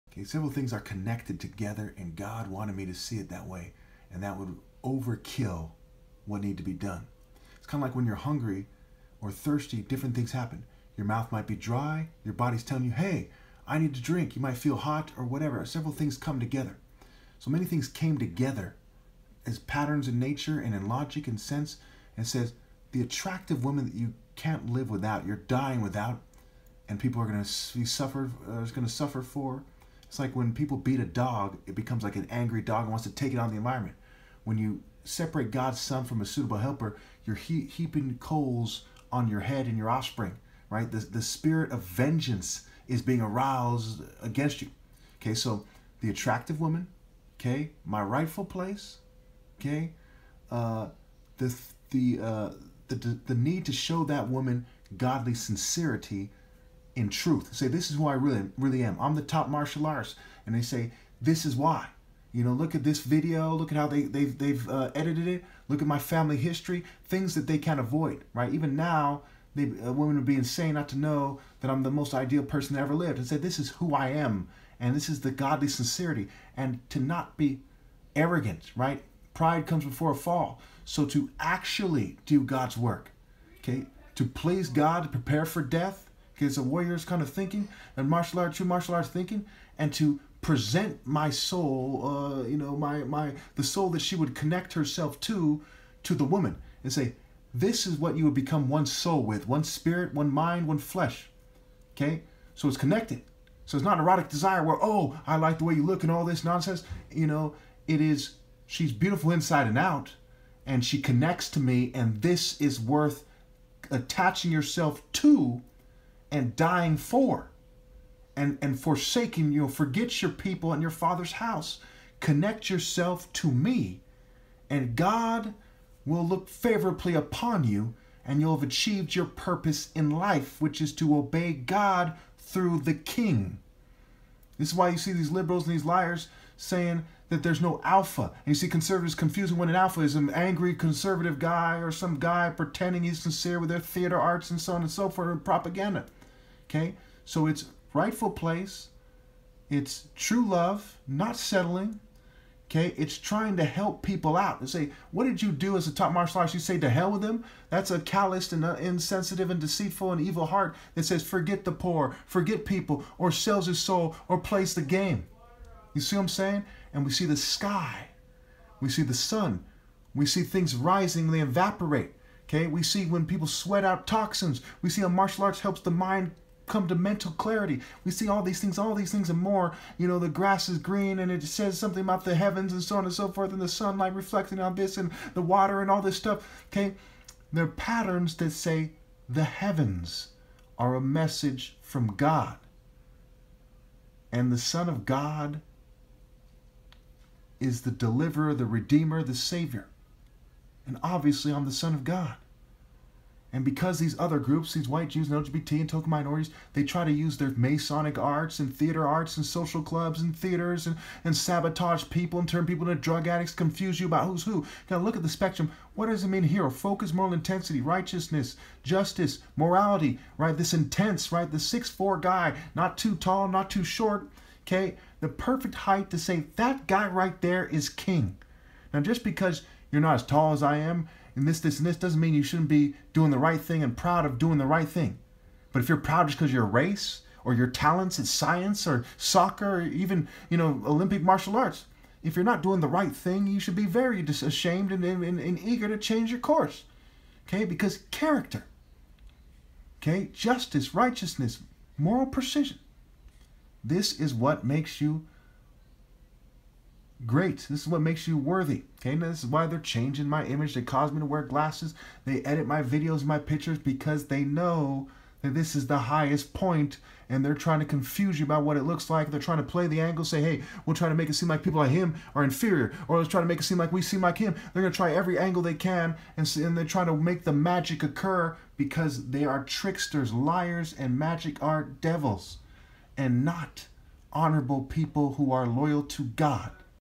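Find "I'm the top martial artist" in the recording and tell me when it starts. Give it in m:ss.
0:58.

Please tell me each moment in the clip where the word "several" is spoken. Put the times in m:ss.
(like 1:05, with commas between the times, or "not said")
0:00, 0:15.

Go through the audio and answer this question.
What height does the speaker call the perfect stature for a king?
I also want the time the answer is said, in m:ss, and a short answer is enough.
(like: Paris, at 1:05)
6'4", at 3:41.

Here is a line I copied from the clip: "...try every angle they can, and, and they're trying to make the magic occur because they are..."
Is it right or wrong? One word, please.
right.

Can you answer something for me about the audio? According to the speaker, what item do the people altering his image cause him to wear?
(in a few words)
glasses.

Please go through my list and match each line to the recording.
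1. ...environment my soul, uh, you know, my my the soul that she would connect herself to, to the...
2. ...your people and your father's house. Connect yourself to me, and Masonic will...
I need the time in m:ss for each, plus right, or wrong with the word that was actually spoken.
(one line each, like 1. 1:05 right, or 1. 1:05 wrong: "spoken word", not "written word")
1. 1:30 wrong: "present", not "environment"
2. 2:00 wrong: "God", not "Masonic".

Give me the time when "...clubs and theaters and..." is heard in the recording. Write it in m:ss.
3:29.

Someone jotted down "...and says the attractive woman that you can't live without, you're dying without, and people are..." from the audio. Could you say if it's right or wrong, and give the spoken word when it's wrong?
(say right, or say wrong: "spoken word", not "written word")
right.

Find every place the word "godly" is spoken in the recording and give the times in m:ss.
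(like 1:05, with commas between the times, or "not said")
0:54, 1:15.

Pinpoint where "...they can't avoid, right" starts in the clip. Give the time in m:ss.
1:07.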